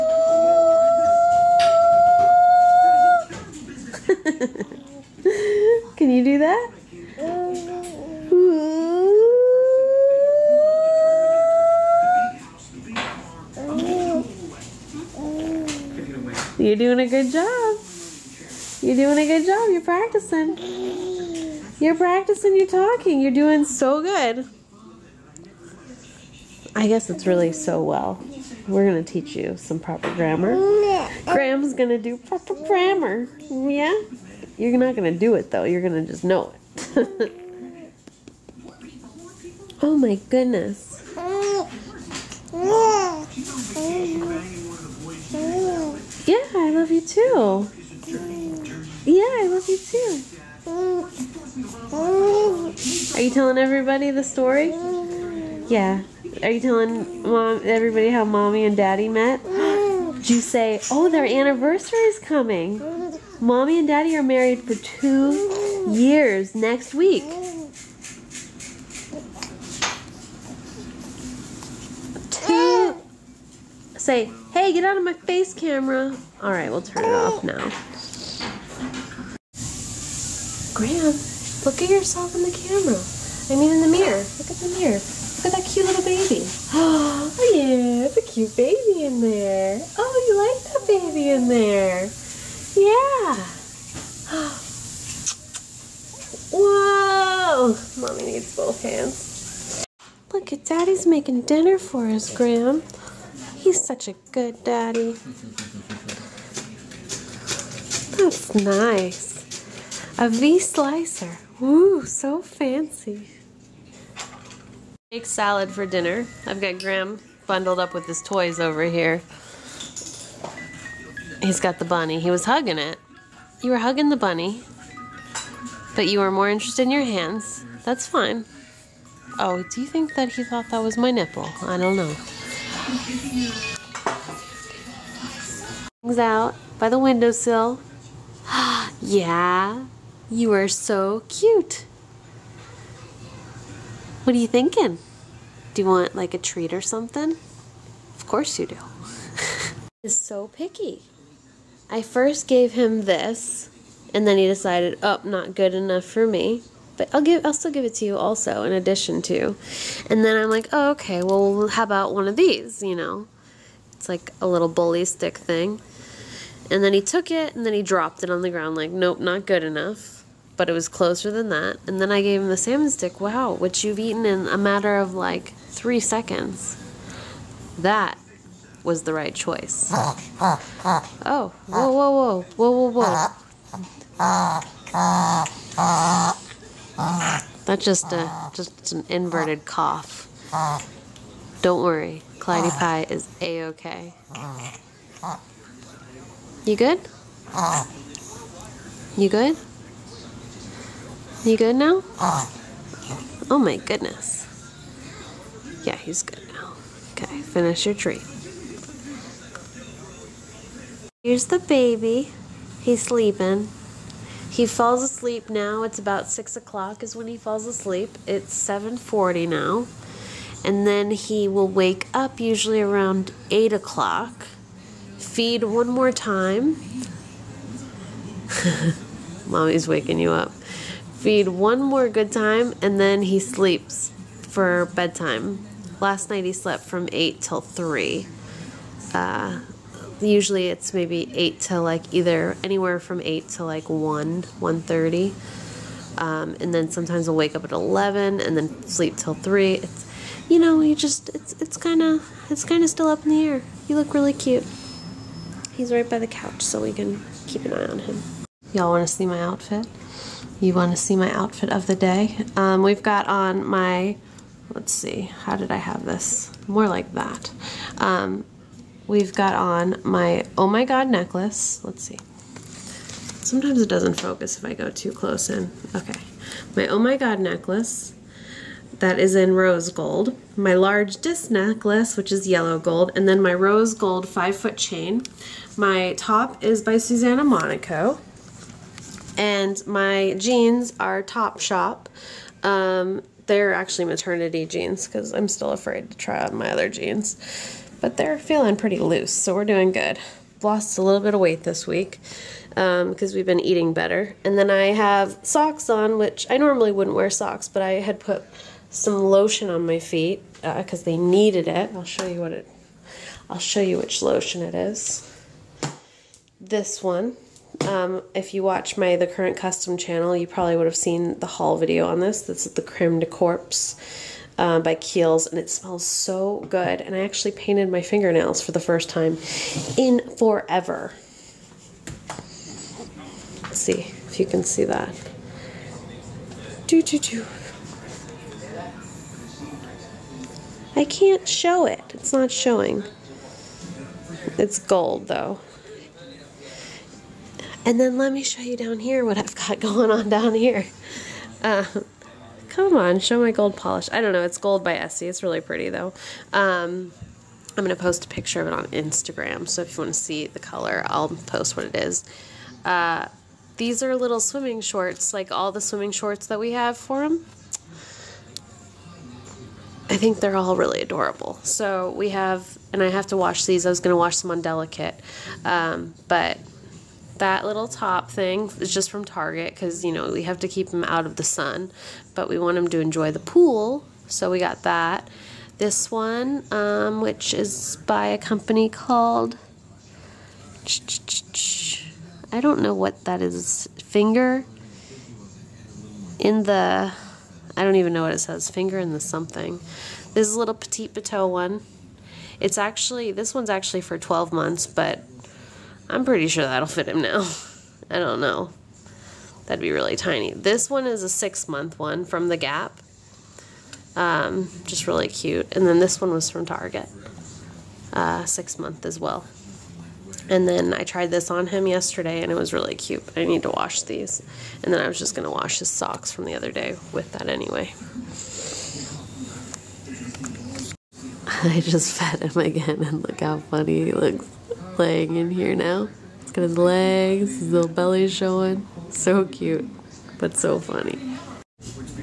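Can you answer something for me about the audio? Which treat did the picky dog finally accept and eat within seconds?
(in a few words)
salmon stick.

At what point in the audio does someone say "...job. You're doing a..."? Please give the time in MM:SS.
00:17.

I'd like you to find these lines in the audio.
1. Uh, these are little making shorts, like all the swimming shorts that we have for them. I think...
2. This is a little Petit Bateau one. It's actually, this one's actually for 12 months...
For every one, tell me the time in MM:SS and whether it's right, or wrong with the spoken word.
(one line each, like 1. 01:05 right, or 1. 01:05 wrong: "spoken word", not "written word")
1. 06:02 wrong: "swimming", not "making"
2. 06:40 right.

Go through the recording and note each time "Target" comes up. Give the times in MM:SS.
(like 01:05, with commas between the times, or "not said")
06:19, 06:56.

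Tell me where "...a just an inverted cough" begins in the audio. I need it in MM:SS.
03:08.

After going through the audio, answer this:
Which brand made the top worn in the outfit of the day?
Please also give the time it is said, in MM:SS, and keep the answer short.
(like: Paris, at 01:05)
Susana Monaco, at 04:46.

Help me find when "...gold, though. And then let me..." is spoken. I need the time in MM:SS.
05:44.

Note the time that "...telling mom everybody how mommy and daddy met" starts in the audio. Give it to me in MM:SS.
00:56.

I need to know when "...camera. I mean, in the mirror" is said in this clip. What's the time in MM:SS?
01:22.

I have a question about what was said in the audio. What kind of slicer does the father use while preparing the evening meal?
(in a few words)
V slicer.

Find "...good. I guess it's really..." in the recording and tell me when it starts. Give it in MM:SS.
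00:24.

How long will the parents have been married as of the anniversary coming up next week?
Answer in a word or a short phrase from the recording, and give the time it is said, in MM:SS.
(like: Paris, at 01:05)
2 years, at 01:04.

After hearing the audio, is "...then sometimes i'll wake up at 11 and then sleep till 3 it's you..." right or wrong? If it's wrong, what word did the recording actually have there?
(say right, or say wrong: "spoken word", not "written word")
right.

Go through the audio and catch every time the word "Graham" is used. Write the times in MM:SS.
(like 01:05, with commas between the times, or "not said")
00:31, 01:20, 01:42, 01:56.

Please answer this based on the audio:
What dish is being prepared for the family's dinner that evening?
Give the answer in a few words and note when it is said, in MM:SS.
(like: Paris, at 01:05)
Egg salad, at 01:55.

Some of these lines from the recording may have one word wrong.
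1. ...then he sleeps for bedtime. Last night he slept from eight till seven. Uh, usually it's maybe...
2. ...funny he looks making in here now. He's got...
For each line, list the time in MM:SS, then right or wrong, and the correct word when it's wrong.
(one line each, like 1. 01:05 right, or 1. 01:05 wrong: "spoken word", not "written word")
1. 03:52 wrong: "three", not "seven"
2. 07:13 wrong: "laying", not "making".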